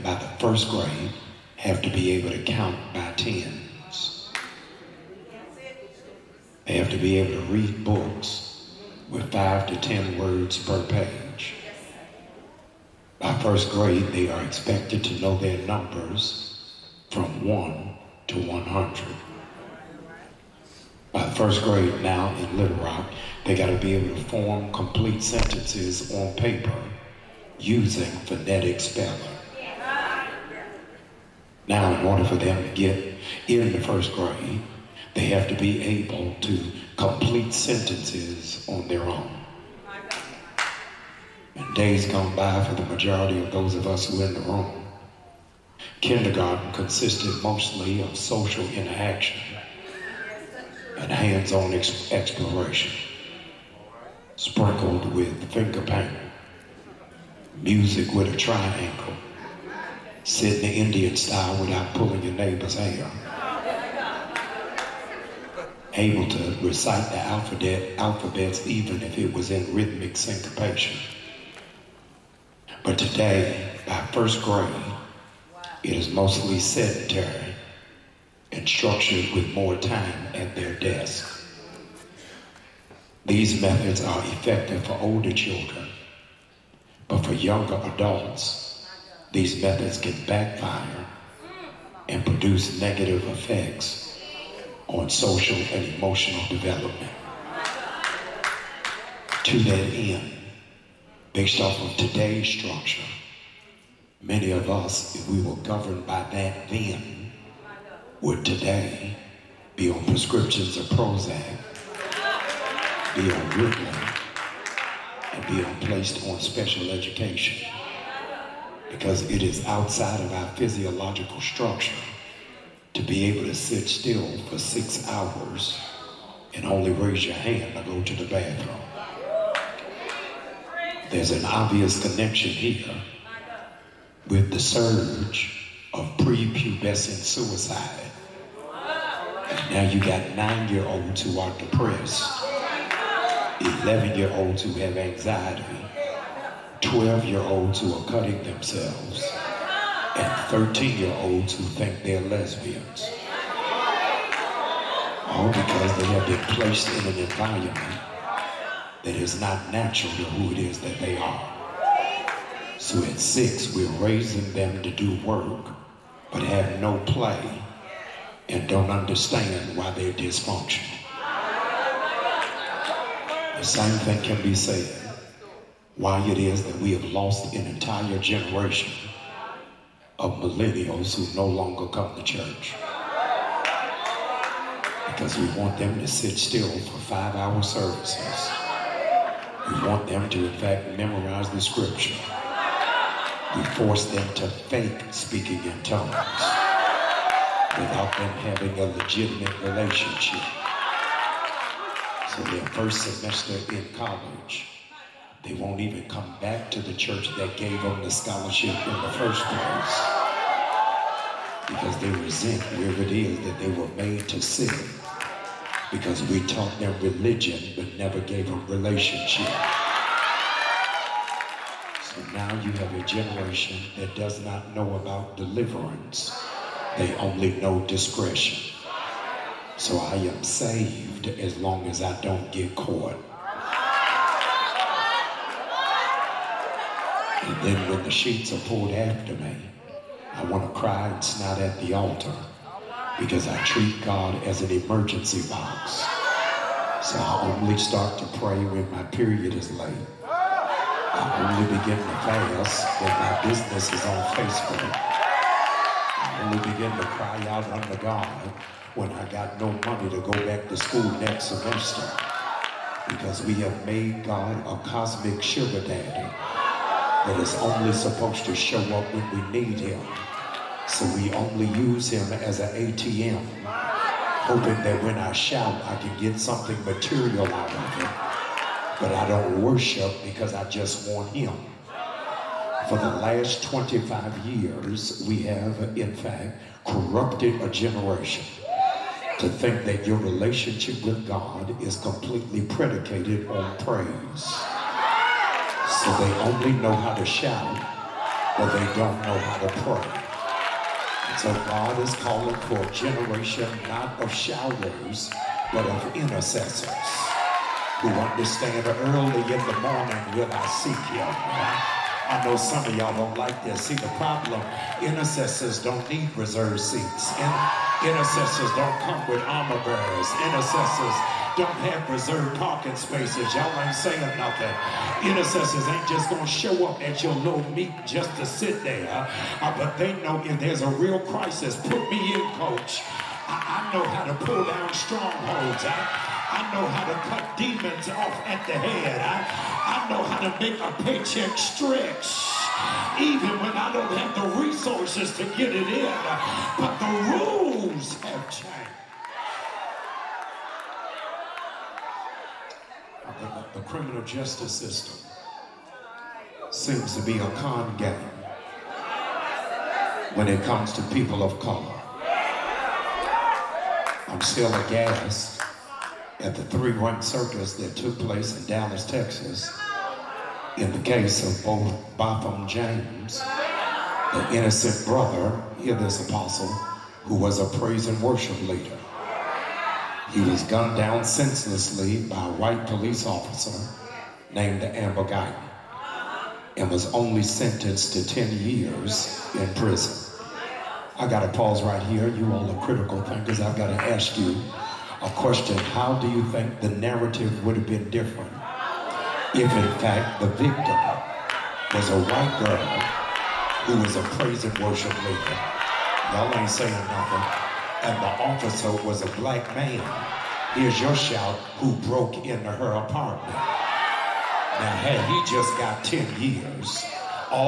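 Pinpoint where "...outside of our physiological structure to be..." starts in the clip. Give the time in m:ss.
1:59.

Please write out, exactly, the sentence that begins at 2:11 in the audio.
There's an obvious connection here with the surge of prepubescent suicide.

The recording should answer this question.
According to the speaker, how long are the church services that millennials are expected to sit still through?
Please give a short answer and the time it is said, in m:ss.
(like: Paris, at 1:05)
5 hours, at 3:06.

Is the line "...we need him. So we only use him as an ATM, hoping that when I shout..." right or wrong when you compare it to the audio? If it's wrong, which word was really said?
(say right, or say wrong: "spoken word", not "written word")
right.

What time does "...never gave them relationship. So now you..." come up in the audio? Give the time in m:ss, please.
3:37.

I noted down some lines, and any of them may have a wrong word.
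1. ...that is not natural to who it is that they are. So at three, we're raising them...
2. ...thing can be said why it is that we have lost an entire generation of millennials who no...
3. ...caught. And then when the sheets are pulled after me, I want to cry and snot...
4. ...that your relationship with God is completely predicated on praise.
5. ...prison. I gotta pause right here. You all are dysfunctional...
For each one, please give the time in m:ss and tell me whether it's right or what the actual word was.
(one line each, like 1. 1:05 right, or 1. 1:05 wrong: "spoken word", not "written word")
1. 2:39 wrong: "six", not "three"
2. 2:53 right
3. 3:52 right
4. 4:49 right
5. 6:29 wrong: "critical", not "dysfunctional".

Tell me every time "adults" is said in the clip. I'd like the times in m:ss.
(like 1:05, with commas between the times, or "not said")
1:27.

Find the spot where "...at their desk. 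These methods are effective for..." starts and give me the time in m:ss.
1:20.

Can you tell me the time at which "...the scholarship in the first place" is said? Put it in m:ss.
3:28.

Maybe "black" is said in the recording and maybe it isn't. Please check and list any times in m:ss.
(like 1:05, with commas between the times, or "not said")
6:49.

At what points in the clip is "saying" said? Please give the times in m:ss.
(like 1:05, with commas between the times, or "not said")
5:23, 6:46.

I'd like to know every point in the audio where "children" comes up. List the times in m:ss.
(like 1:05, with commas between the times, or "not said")
1:25.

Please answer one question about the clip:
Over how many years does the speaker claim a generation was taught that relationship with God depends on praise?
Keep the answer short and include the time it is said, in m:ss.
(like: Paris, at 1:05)
25, at 4:43.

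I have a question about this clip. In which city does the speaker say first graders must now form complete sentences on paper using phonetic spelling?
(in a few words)
Little Rock.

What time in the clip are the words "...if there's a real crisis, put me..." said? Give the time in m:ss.
5:30.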